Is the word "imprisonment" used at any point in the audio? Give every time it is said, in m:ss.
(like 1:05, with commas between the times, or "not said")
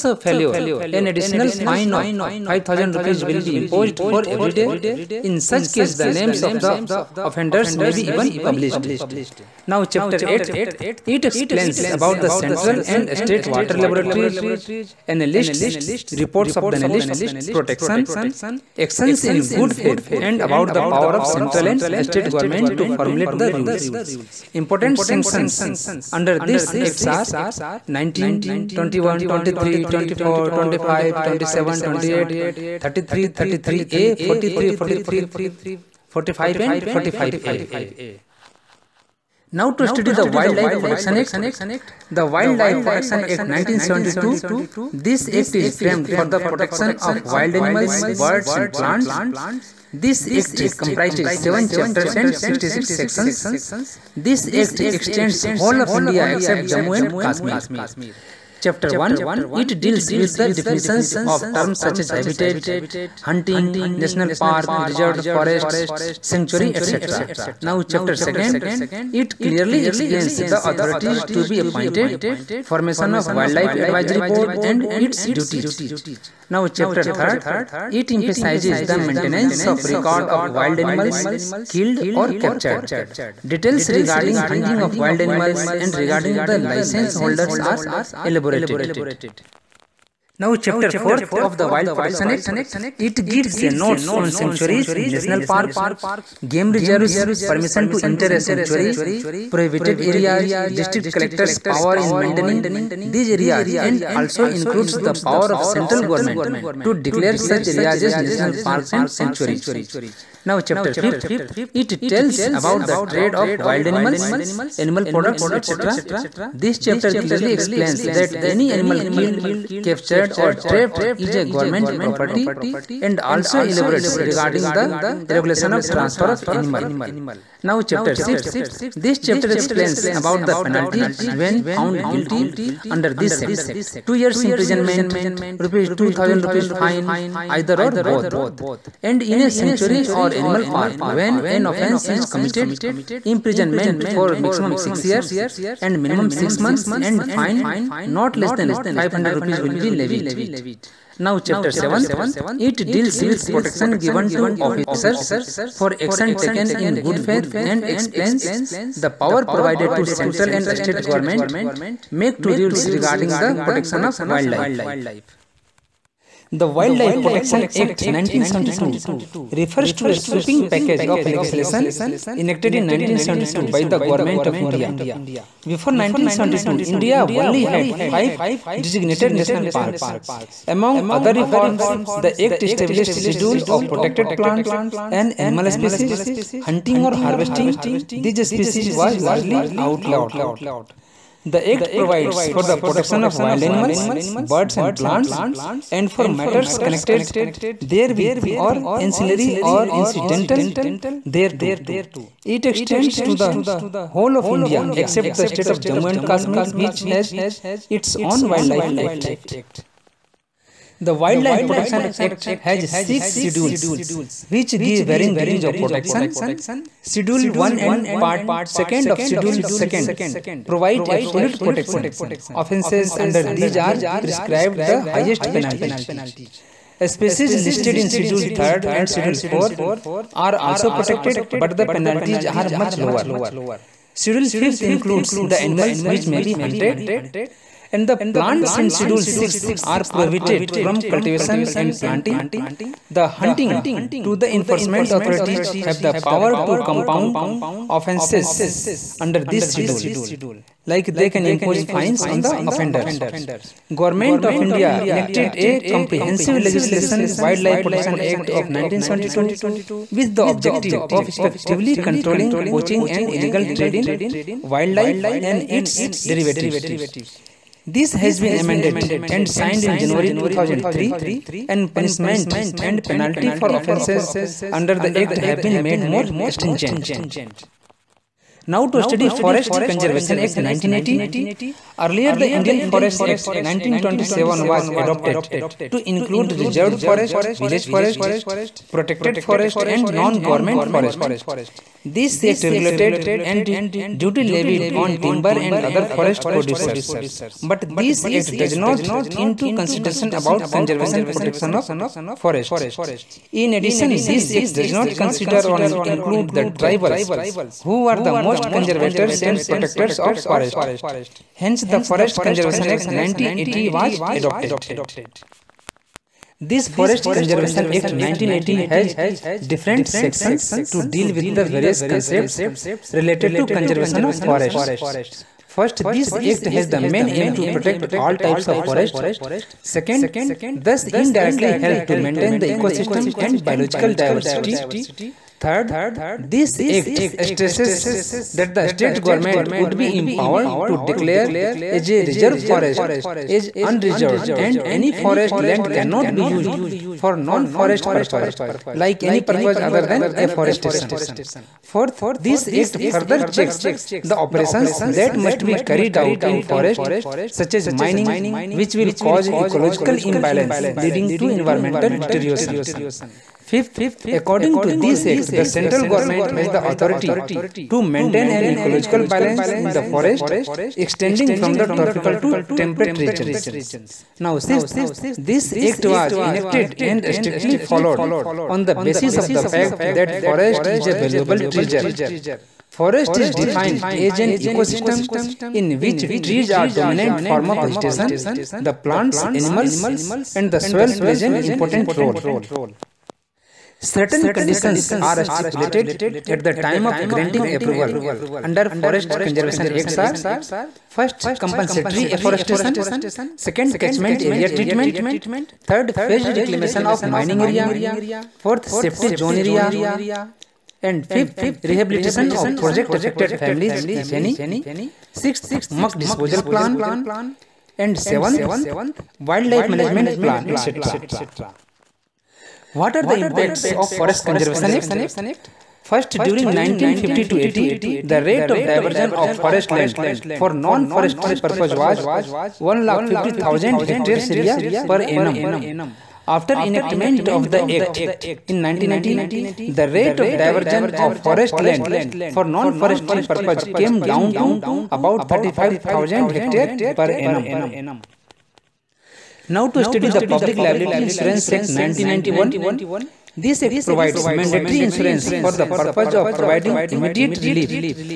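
2:14, 2:23.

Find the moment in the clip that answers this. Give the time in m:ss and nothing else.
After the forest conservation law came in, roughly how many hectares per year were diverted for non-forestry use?
7:25.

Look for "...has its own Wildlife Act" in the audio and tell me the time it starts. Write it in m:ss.
3:27.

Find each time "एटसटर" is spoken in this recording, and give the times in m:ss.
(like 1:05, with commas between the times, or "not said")
7:00.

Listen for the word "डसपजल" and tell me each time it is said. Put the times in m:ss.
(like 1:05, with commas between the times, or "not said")
6:56.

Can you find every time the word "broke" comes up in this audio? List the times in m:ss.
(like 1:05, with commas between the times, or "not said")
not said.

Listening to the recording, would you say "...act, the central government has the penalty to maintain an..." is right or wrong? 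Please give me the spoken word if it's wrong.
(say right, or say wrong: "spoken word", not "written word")
wrong: "authority", not "penalty".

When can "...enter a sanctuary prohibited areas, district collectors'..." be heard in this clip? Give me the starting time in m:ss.
1:38.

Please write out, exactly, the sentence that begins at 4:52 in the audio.
This act regulated and duty levied on timber and other forest producers.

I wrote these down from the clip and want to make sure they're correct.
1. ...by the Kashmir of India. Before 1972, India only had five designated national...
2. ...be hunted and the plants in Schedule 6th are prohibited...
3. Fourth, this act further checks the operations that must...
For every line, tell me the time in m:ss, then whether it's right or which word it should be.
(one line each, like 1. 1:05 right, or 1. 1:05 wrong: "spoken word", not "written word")
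1. 2:53 wrong: "Government", not "Kashmir"
2. 3:56 right
3. 5:51 right.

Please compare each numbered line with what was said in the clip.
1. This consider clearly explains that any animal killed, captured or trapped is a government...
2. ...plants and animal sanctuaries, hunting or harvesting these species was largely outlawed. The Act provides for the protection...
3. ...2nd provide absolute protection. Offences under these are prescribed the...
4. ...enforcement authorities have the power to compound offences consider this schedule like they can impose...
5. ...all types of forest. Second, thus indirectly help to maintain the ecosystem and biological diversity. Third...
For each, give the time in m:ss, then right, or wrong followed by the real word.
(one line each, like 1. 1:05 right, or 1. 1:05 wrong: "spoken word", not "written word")
1. 1:56 wrong: "chapter", not "consider"
2. 3:04 wrong: "species", not "sanctuaries"
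3. 3:39 right
4. 4:04 wrong: "under", not "consider"
5. 5:28 right.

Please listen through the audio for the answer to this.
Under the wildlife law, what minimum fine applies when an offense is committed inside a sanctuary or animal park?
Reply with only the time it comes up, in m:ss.
2:28.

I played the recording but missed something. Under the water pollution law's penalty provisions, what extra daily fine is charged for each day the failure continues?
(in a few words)
5000 rupees.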